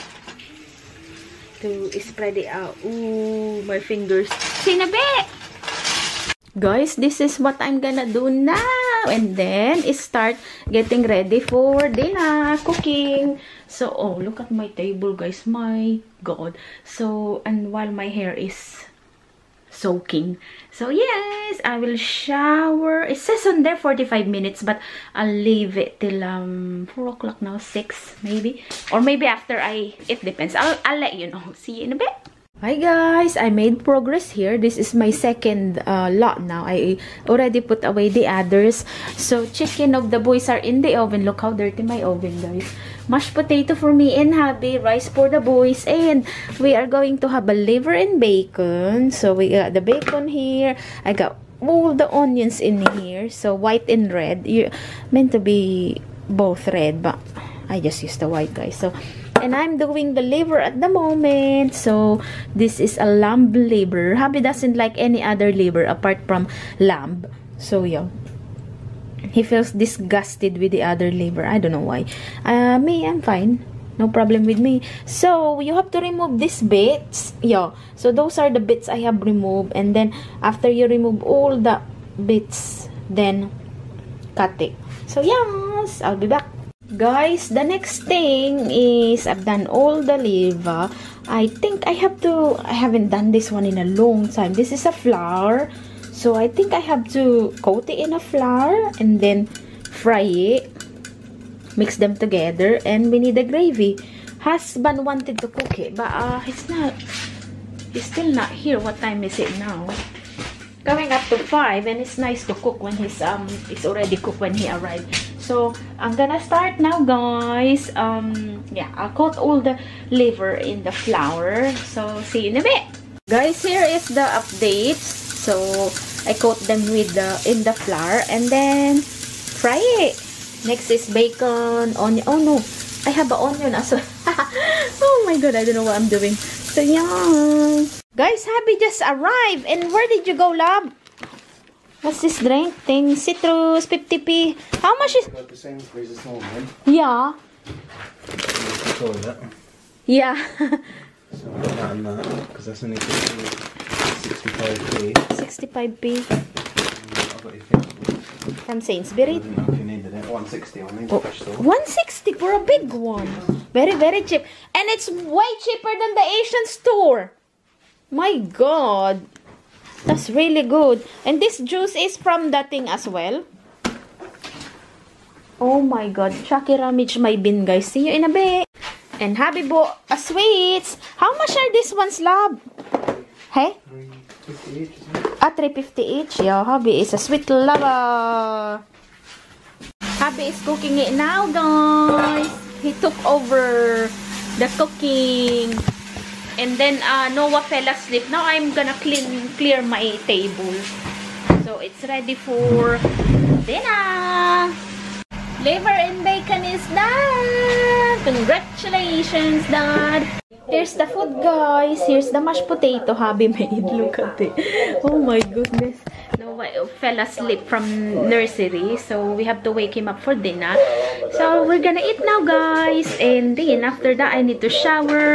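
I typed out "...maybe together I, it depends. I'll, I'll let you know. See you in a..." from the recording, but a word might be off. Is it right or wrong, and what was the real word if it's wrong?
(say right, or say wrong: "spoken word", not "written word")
wrong: "after", not "together".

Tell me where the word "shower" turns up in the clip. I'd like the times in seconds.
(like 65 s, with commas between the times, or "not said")
21 s, 224 s.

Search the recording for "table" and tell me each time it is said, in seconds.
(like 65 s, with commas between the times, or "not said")
14 s, 200 s.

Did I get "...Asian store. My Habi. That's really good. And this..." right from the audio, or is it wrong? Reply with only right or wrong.
wrong.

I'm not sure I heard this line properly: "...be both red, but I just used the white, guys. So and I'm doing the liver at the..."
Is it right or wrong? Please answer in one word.
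right.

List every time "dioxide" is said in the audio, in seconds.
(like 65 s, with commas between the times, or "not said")
not said.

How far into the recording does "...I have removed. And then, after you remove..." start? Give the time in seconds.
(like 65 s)
78 s.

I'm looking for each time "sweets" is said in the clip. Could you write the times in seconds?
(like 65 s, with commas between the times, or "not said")
180 s, 187 s.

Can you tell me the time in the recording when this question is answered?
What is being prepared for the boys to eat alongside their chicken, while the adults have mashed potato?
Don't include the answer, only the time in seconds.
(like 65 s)
44 s.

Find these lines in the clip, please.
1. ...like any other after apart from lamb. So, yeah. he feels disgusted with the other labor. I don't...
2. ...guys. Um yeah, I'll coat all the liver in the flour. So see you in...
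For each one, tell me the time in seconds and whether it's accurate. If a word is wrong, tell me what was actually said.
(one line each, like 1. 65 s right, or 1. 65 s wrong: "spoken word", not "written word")
1. 64 s wrong: "liver", not "after"
2. 116 s right.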